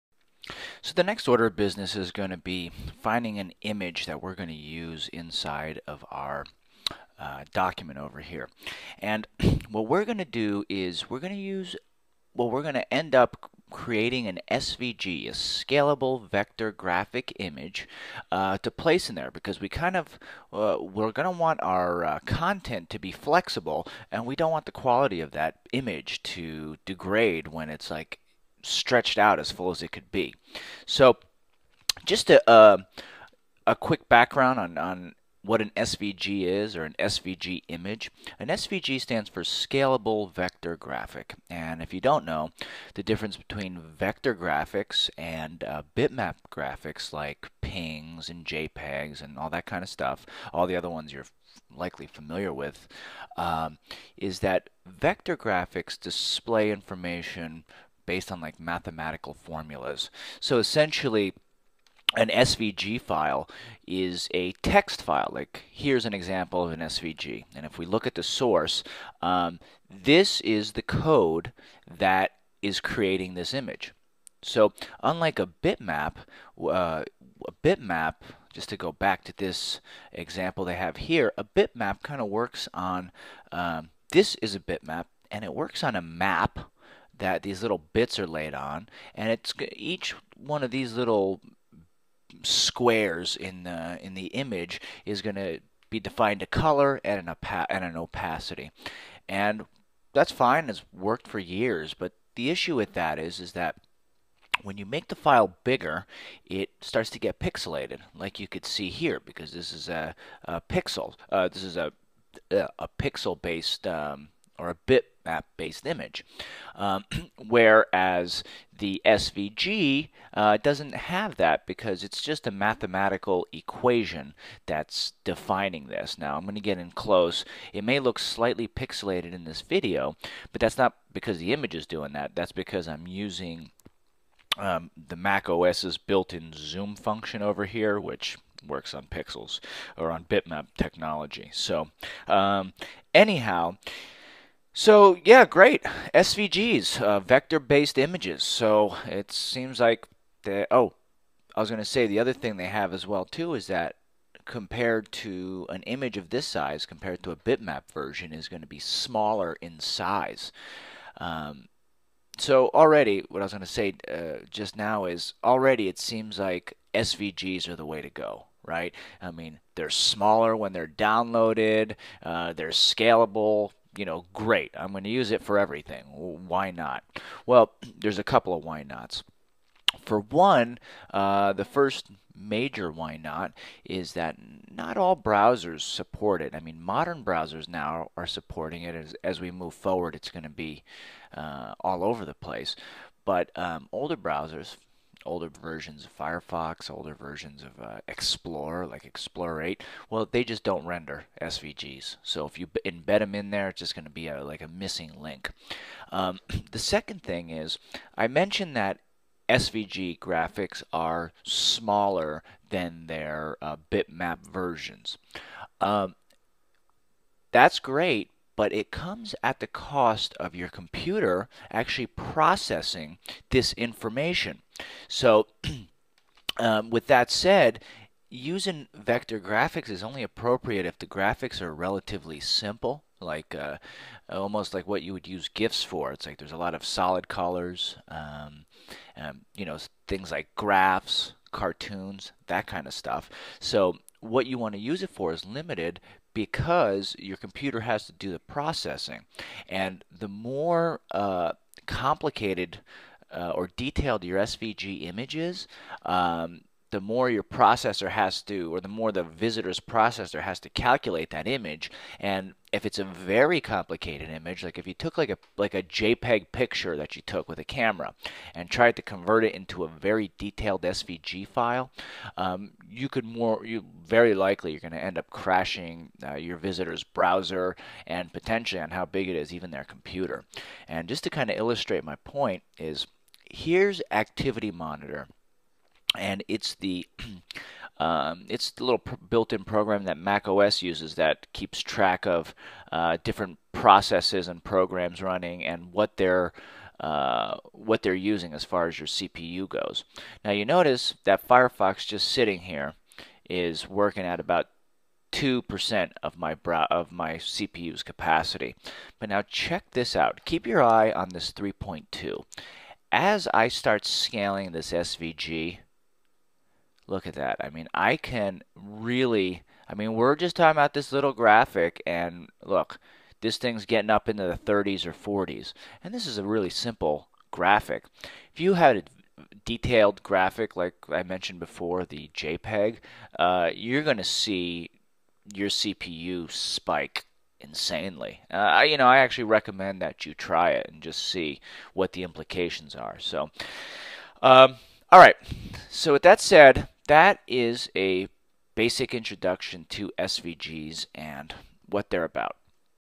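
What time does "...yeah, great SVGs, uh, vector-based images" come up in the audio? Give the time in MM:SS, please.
02:25.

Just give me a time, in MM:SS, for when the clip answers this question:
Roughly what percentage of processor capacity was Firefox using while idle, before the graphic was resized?
05:05.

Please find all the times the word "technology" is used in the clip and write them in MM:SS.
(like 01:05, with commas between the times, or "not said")
02:20.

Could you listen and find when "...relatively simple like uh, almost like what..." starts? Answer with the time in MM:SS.
03:51.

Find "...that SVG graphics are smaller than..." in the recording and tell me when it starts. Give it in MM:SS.
03:28.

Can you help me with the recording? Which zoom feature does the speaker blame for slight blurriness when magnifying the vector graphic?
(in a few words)
Mac OS built-in zoom.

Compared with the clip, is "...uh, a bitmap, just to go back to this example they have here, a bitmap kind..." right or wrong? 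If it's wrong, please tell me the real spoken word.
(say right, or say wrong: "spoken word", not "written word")
right.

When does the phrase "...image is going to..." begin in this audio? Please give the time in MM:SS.
01:34.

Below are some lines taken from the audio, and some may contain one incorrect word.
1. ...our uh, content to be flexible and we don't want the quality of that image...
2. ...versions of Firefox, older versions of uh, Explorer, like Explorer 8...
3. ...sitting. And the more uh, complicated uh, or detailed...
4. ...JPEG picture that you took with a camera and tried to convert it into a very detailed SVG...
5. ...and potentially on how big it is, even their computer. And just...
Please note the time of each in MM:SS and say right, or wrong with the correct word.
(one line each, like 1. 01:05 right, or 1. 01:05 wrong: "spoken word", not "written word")
1. 00:21 right
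2. 03:15 right
3. 04:08 wrong: "processing", not "sitting"
4. 04:25 right
5. 04:38 right.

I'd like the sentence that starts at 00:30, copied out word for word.
So, just a uh, a quick background on on what an SVG is or an SVG image.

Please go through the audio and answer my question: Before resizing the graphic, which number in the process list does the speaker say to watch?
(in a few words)
3.2.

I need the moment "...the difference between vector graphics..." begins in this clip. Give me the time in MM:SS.
00:42.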